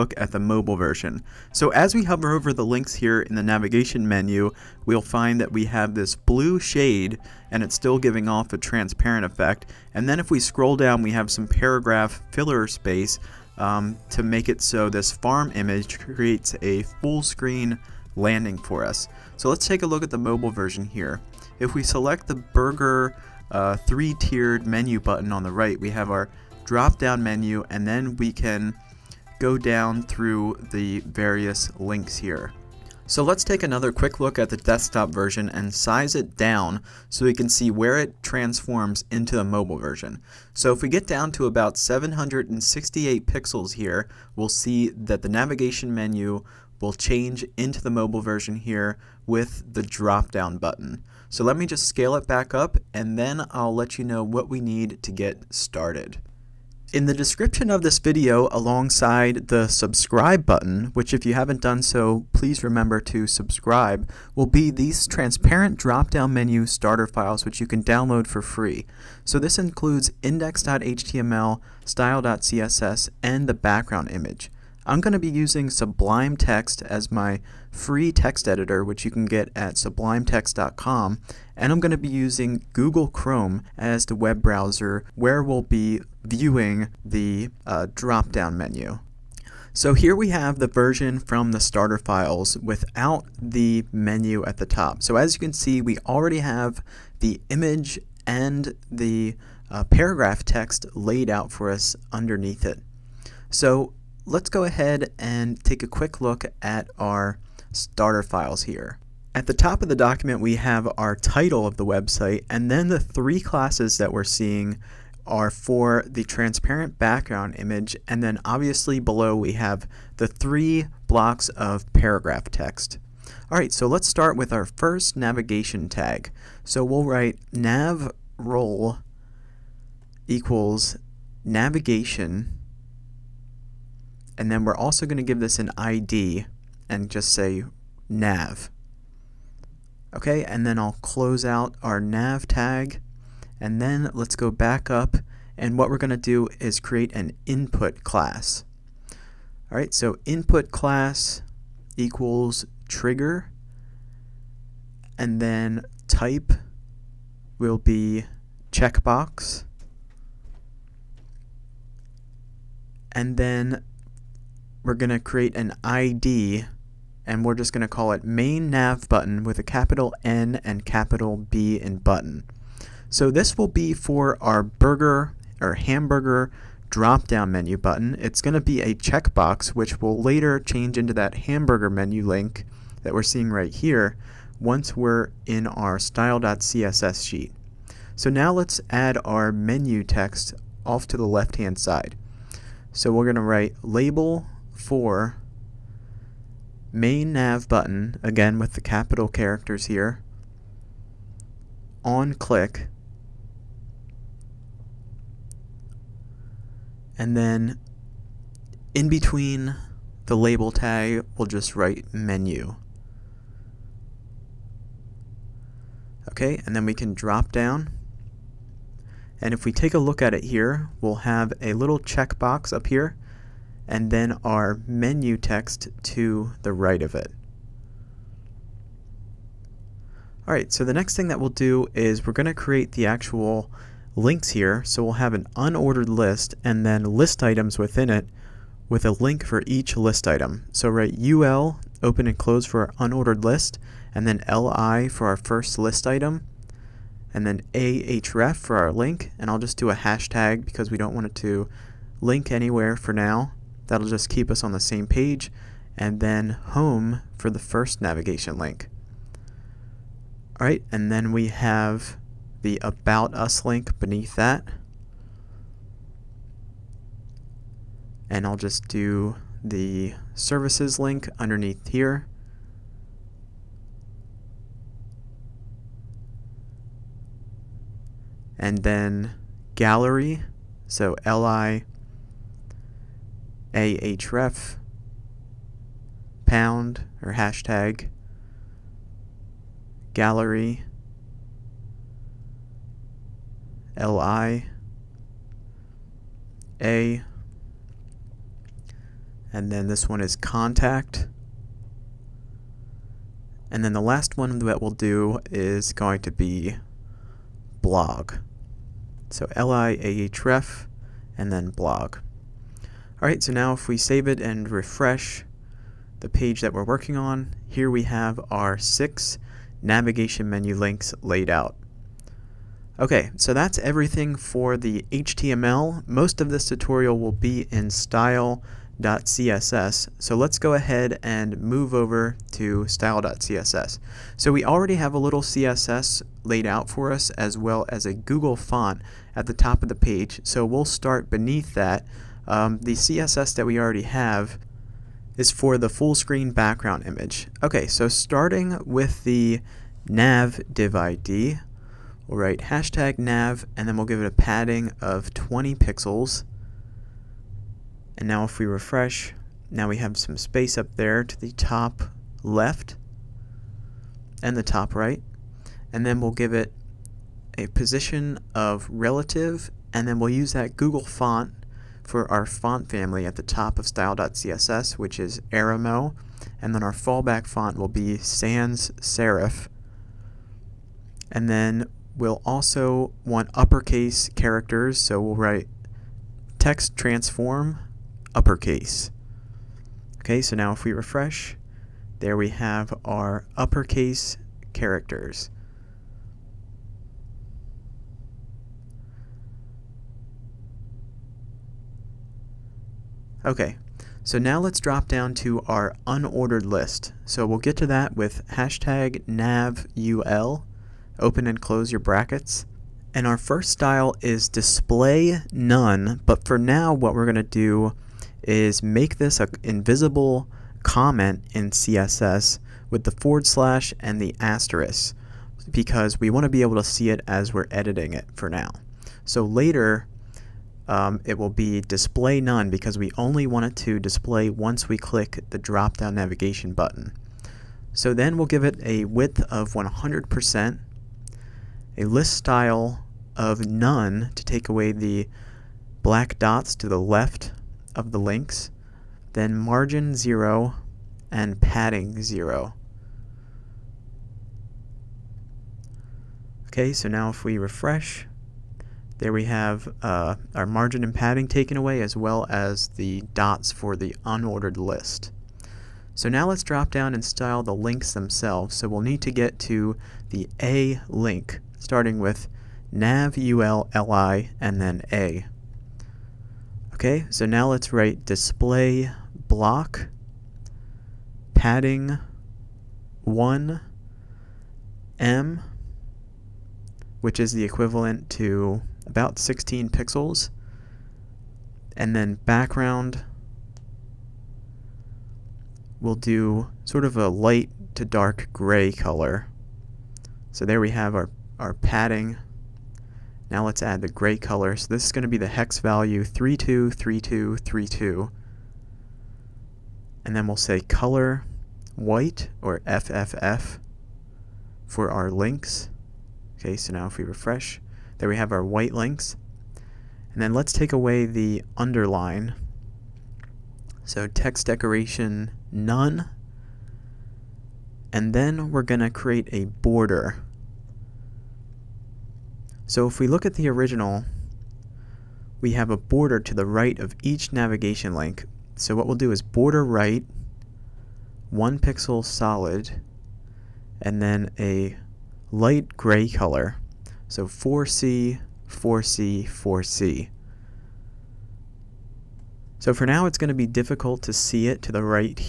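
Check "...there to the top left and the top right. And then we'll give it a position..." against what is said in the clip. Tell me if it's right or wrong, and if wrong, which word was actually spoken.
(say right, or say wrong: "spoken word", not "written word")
right.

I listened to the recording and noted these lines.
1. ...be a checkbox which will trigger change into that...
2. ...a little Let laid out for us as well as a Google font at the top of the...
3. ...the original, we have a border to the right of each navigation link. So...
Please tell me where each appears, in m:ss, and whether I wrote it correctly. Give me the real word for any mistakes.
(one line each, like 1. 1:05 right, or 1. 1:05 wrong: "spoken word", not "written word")
1. 2:58 wrong: "later", not "trigger"
2. 5:35 wrong: "CSS", not "Let"
3. 8:53 right.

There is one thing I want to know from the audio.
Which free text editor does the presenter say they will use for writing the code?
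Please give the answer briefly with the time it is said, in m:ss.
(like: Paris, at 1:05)
Sublime Text, at 1:15.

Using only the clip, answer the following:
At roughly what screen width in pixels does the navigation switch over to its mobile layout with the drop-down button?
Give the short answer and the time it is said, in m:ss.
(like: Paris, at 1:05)
768, at 0:41.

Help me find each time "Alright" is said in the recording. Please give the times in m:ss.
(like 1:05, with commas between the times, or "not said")
2:03, 3:50, 5:13.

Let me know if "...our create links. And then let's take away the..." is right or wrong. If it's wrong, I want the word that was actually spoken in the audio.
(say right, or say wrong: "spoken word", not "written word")
wrong: "white", not "create".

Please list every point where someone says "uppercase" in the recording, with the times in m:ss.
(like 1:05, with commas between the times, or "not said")
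6:23, 6:28, 6:33.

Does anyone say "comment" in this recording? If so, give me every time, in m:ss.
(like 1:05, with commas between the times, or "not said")
7:00.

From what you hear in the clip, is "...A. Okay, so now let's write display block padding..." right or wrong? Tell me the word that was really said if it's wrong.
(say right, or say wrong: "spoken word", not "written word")
right.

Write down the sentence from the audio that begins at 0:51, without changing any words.
So let me just scale it back up and then I'll let you know what we need to get started.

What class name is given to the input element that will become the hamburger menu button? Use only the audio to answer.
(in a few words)
trigger.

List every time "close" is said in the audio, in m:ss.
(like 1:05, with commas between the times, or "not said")
2:20, 4:02, 6:51.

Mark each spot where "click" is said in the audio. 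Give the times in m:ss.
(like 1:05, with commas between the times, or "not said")
3:22, 7:14.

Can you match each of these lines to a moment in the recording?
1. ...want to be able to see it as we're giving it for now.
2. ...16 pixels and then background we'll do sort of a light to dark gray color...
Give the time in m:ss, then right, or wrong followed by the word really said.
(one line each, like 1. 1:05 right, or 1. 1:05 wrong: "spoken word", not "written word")
1. 7:06 wrong: "editing", not "giving"
2. 8:09 right.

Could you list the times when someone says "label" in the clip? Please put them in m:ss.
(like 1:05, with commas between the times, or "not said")
3:13, 3:30.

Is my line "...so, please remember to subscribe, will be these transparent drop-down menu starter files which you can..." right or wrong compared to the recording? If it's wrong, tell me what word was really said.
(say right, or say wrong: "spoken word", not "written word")
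right.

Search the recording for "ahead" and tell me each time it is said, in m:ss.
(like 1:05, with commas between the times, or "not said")
1:44, 5:30.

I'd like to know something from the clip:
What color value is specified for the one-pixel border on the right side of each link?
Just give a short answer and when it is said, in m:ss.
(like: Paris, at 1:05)
4C4C4C, at 9:07.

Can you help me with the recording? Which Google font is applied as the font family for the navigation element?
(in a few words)
Arimo.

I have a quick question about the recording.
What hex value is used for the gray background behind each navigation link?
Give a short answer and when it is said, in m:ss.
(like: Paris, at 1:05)
323232, at 8:26.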